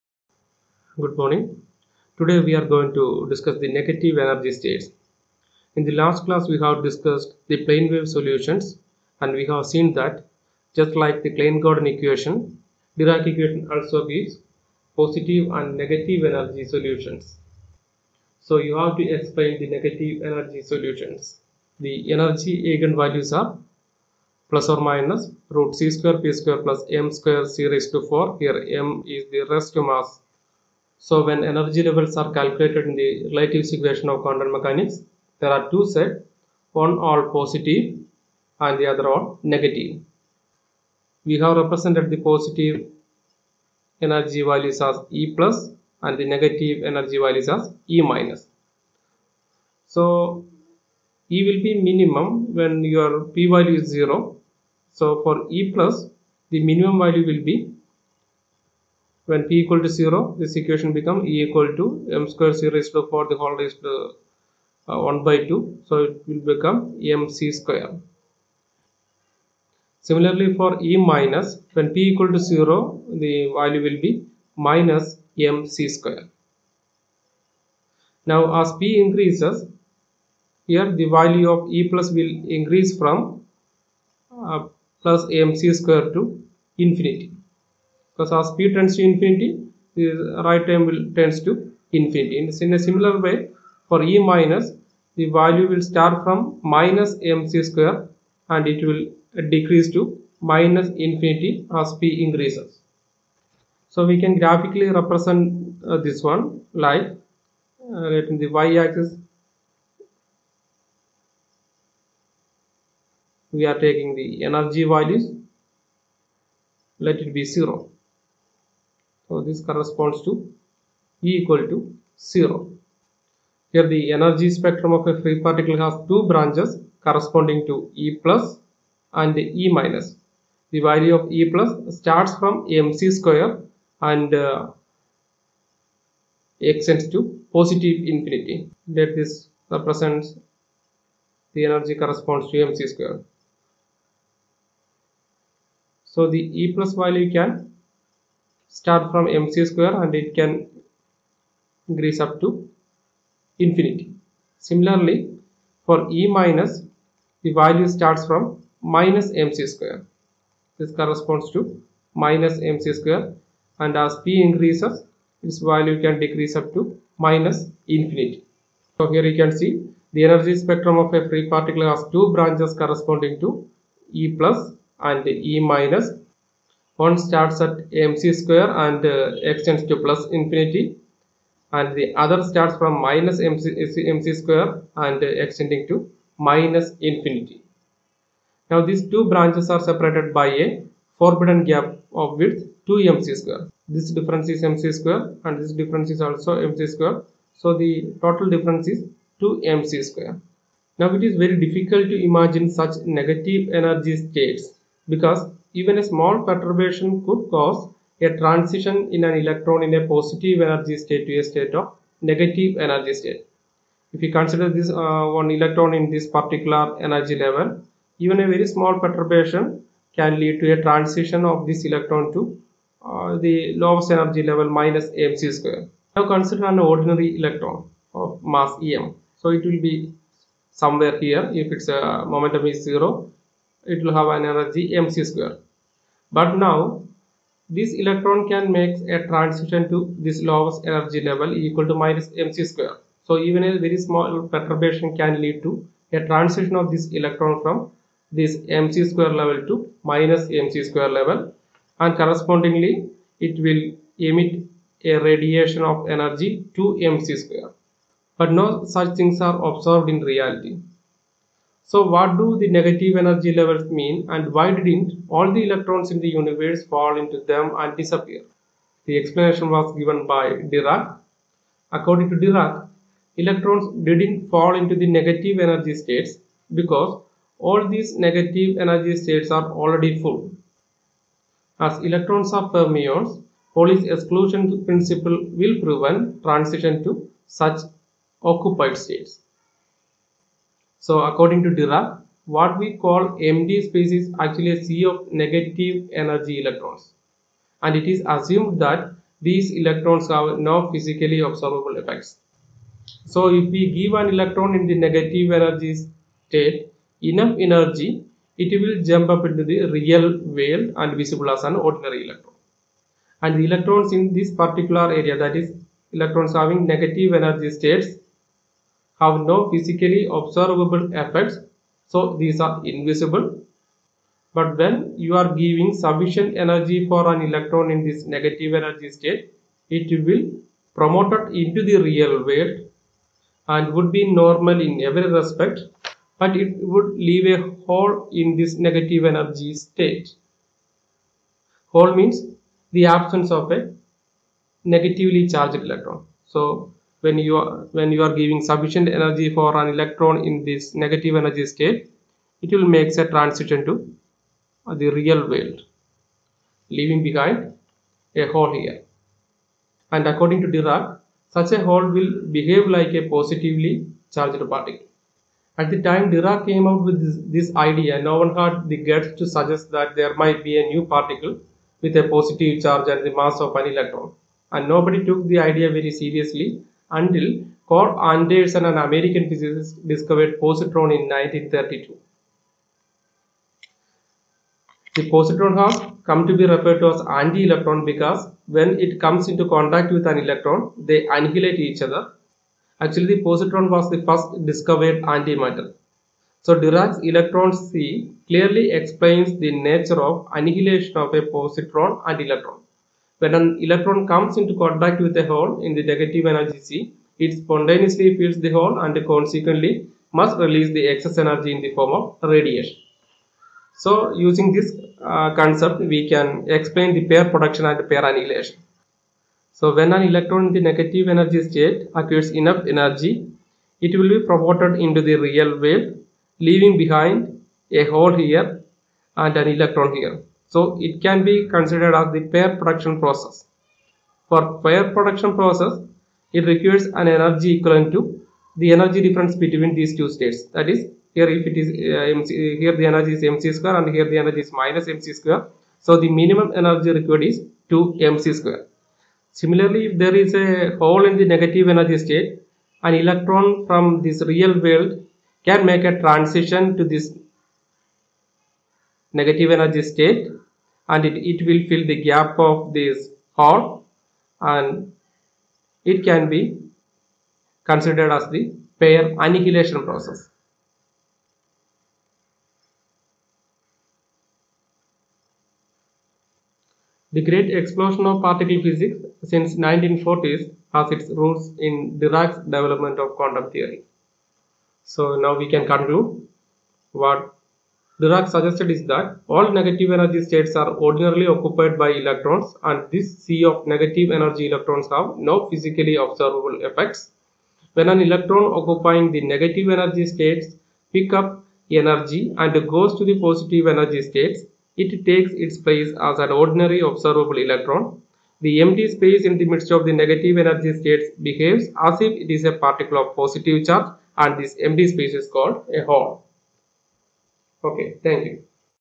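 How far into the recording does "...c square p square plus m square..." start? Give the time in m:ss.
0:25.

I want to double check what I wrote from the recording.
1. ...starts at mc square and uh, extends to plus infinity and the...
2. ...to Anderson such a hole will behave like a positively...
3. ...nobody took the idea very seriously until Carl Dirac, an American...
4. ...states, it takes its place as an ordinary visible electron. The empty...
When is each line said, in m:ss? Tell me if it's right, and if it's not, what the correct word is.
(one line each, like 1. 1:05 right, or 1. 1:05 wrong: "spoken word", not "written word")
1. 2:57 right
2. 6:00 wrong: "Dirac", not "Anderson"
3. 6:14 wrong: "Anderson", not "Dirac"
4. 8:24 wrong: "observable", not "visible".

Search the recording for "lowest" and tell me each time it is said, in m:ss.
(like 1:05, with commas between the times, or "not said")
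3:43, 4:00.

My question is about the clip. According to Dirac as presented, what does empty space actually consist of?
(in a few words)
a sea of negative energy electrons.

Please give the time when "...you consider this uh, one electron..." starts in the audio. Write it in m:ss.
3:34.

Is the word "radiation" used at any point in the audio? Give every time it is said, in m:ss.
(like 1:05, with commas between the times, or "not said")
4:15, 6:52.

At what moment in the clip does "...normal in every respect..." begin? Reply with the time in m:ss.
5:34.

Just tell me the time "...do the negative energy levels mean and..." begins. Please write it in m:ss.
4:22.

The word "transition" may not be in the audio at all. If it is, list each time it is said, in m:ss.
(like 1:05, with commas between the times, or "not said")
3:28, 3:40, 3:59, 4:06, 4:46, 5:53, 7:36.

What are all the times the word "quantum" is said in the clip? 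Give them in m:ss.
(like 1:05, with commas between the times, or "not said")
0:34, 8:03.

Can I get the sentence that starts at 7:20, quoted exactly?
That is, here if it is uh, MC, here the energy is mc square and here the energy is minus mc square.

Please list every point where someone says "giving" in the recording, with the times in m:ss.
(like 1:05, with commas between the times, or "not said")
5:25, 5:48.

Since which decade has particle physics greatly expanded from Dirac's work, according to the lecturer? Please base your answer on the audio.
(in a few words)
1940s.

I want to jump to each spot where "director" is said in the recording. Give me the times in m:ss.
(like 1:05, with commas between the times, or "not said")
not said.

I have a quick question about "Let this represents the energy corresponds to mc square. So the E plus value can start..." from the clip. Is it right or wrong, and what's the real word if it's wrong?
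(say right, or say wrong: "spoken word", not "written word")
right.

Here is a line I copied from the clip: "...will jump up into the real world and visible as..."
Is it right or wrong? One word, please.
right.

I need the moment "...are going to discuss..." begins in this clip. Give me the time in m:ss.
0:02.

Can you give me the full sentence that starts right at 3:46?
Now consider an ordinary electron of mass em.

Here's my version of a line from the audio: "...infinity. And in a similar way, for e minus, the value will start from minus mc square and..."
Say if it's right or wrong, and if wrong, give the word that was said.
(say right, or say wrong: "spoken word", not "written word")
right.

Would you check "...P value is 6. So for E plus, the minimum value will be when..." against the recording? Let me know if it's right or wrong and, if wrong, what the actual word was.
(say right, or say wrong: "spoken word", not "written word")
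wrong: "0", not "6".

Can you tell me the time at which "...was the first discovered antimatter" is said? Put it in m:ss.
6:33.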